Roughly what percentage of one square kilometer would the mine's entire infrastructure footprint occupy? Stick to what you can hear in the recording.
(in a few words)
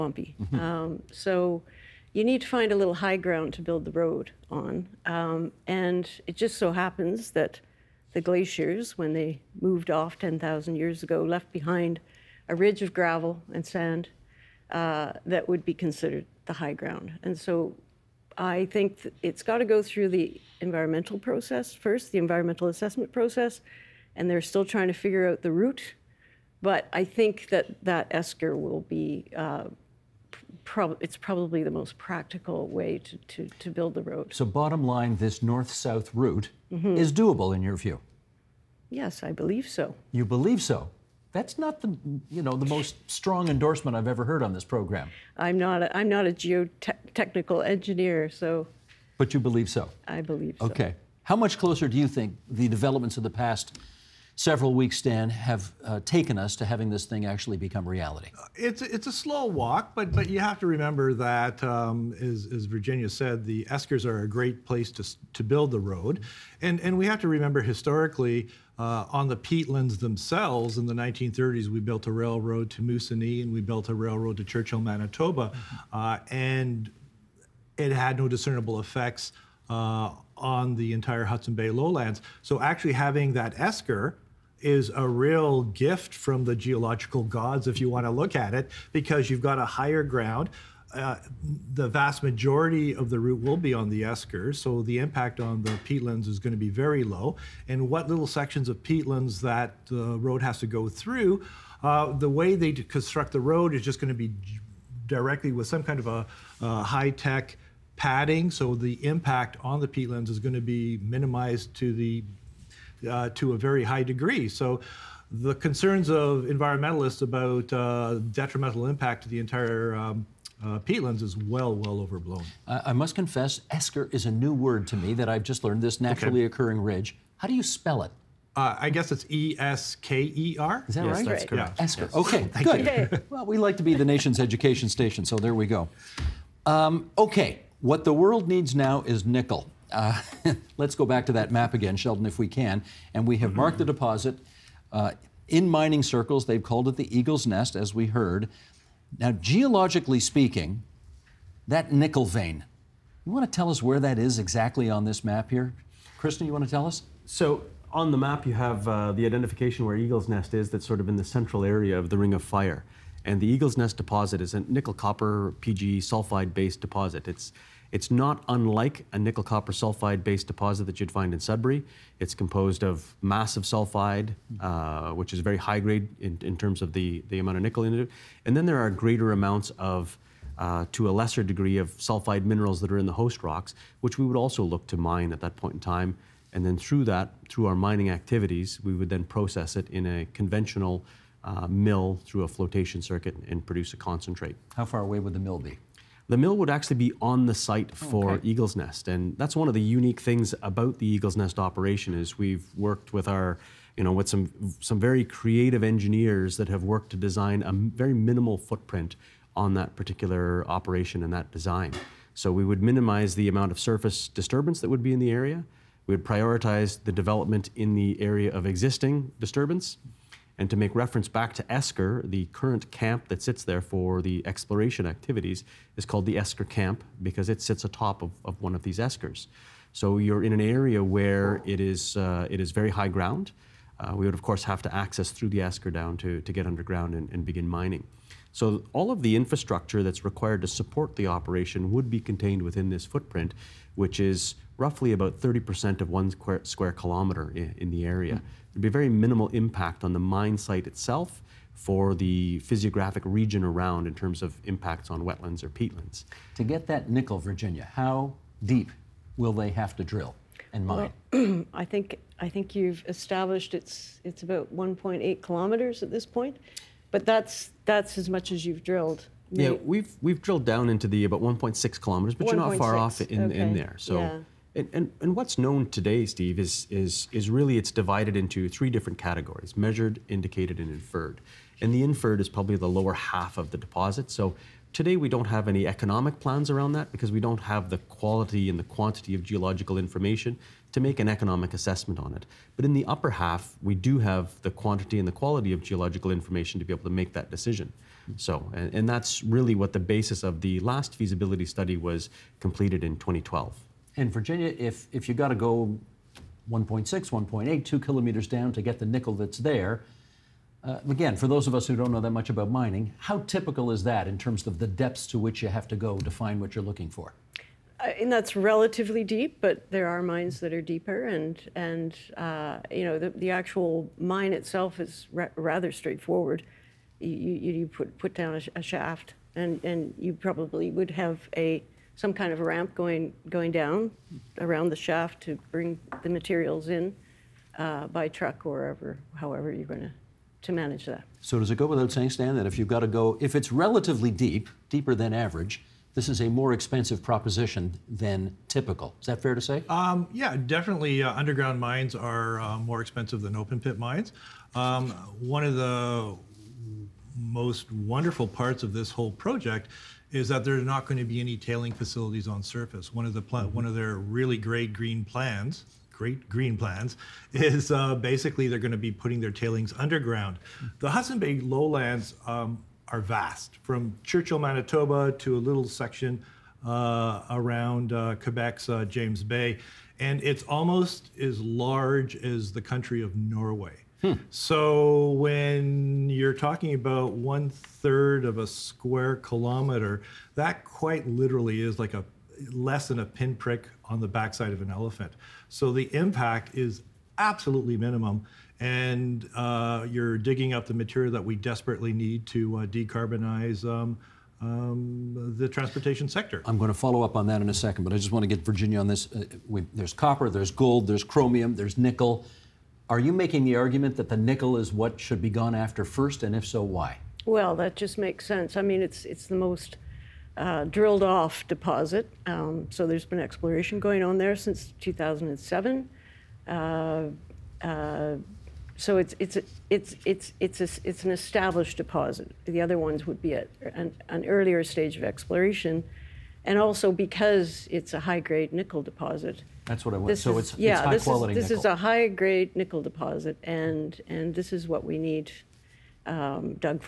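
30%.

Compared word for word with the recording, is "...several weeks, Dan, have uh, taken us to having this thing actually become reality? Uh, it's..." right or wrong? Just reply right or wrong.
right.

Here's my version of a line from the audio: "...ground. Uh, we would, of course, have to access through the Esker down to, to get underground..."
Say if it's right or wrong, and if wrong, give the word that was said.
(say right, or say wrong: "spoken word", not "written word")
right.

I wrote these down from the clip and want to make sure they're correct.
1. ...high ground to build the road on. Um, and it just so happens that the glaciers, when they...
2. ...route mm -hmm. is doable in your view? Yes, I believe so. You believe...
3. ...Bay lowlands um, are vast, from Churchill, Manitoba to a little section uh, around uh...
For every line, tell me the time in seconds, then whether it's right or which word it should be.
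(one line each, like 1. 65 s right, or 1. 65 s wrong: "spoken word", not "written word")
1. 2 s right
2. 36 s right
3. 371 s right.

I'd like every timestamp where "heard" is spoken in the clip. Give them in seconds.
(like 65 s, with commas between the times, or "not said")
44 s, 148 s.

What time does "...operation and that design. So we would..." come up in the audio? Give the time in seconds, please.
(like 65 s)
210 s.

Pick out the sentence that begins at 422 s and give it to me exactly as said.
Um, so there's been exploration going on there since 2007.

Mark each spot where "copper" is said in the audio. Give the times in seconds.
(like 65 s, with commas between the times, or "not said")
164 s, 169 s, 410 s.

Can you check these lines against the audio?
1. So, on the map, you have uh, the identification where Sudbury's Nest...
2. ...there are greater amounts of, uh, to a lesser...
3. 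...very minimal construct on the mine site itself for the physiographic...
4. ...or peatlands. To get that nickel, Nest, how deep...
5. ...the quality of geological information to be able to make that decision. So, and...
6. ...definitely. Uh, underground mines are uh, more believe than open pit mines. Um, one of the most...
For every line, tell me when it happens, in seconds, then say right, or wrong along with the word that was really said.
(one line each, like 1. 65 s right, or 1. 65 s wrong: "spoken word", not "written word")
1. 157 s wrong: "Eagle", not "Sudbury"
2. 178 s right
3. 248 s wrong: "impact", not "construct"
4. 255 s wrong: "Virginia", not "Nest"
5. 295 s right
6. 350 s wrong: "expensive", not "believe".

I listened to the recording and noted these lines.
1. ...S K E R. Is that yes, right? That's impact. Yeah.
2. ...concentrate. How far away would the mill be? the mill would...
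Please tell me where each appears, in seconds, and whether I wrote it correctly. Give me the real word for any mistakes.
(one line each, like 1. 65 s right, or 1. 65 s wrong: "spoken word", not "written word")
1. 129 s wrong: "correct", not "impact"
2. 193 s right.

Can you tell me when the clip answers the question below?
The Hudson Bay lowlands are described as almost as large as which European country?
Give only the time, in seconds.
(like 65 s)
383 s.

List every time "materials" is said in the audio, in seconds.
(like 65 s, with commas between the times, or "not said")
336 s, 400 s.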